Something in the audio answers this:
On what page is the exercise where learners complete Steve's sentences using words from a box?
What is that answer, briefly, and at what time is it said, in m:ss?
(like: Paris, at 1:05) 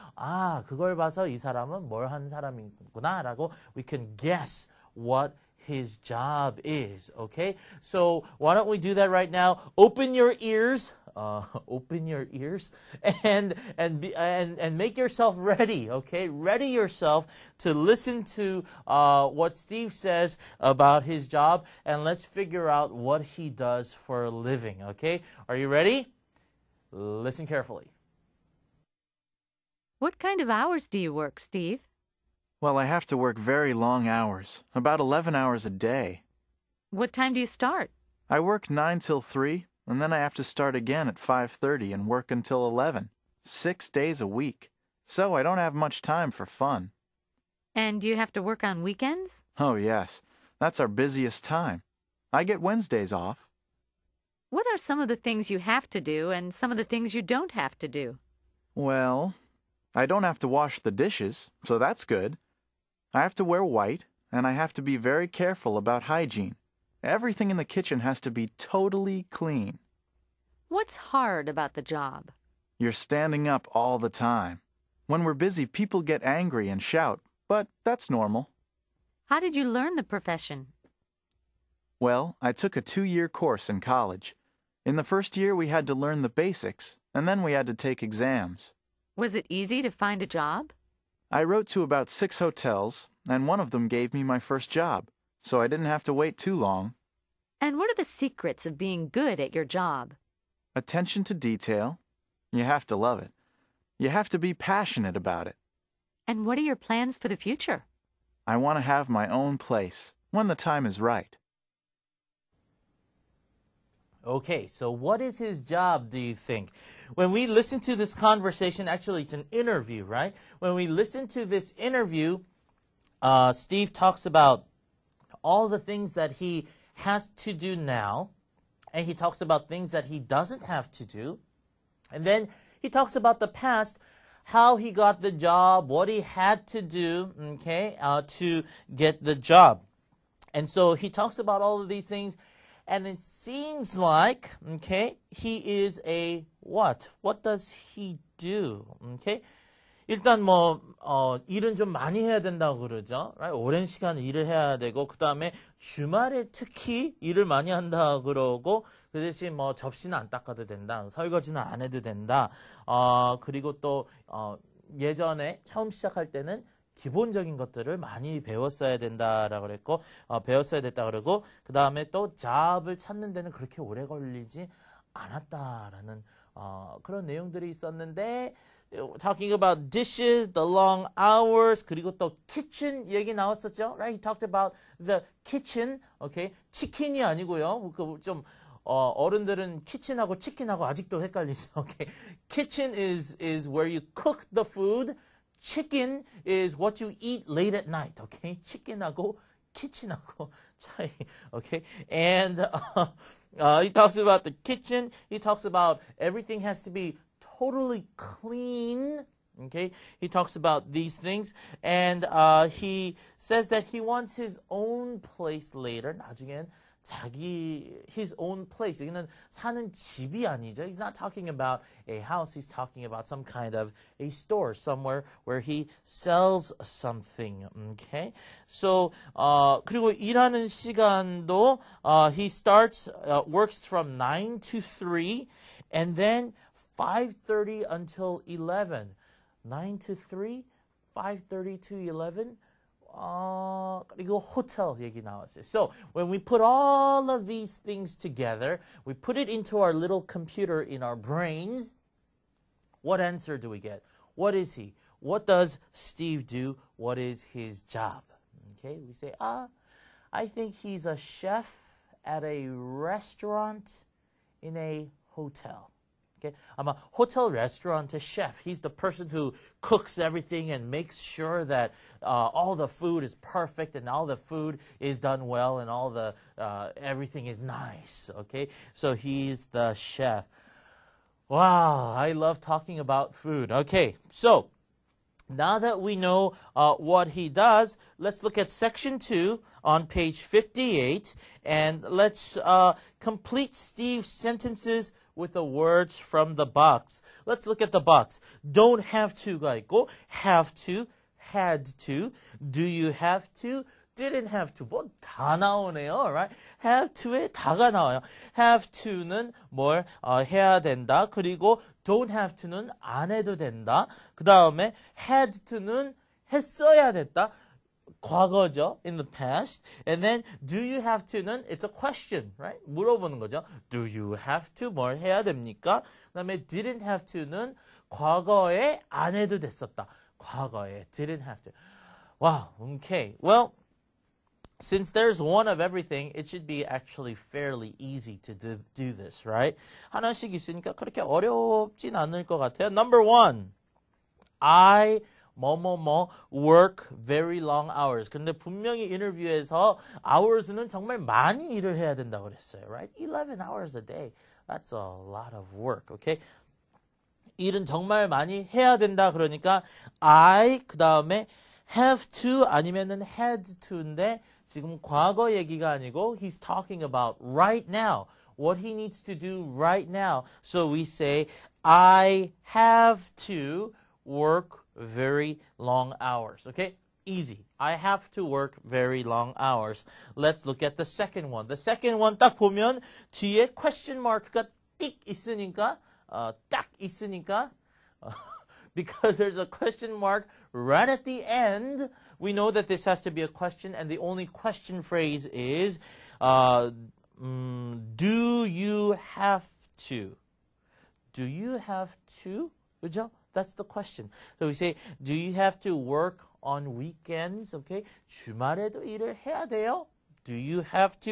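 58, at 4:50.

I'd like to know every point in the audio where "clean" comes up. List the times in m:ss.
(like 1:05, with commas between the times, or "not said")
1:09, 3:28.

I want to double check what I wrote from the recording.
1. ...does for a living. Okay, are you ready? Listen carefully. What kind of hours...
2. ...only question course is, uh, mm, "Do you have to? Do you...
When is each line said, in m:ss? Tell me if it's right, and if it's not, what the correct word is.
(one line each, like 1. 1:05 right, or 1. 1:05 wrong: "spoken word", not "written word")
1. 0:23 right
2. 6:34 wrong: "phrase", not "course".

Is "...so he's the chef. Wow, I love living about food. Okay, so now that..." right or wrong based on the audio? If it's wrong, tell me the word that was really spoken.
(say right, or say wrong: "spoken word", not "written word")
wrong: "talking", not "living".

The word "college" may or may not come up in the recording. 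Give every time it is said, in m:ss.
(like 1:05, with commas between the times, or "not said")
1:23.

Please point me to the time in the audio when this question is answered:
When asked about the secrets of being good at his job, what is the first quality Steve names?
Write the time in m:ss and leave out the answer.
1:40.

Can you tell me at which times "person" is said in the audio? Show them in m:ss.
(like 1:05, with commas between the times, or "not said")
4:28.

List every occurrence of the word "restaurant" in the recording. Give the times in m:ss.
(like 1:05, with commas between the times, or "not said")
4:22, 4:27.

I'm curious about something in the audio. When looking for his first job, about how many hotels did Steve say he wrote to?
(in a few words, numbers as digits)
6.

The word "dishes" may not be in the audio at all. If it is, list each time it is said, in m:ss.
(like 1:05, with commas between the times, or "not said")
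1:00, 2:59.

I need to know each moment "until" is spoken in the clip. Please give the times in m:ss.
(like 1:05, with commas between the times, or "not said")
0:42, 3:57.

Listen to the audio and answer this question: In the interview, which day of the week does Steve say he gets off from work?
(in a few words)
Wednesdays.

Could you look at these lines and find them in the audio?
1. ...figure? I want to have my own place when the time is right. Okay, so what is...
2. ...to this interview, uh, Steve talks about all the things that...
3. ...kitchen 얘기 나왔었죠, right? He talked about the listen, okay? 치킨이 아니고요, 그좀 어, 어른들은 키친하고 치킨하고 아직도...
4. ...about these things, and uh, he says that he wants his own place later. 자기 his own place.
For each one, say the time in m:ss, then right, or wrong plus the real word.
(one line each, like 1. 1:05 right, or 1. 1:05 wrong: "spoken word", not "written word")
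1. 1:47 wrong: "future", not "figure"
2. 2:01 right
3. 3:02 wrong: "kitchen", not "listen"
4. 3:30 right.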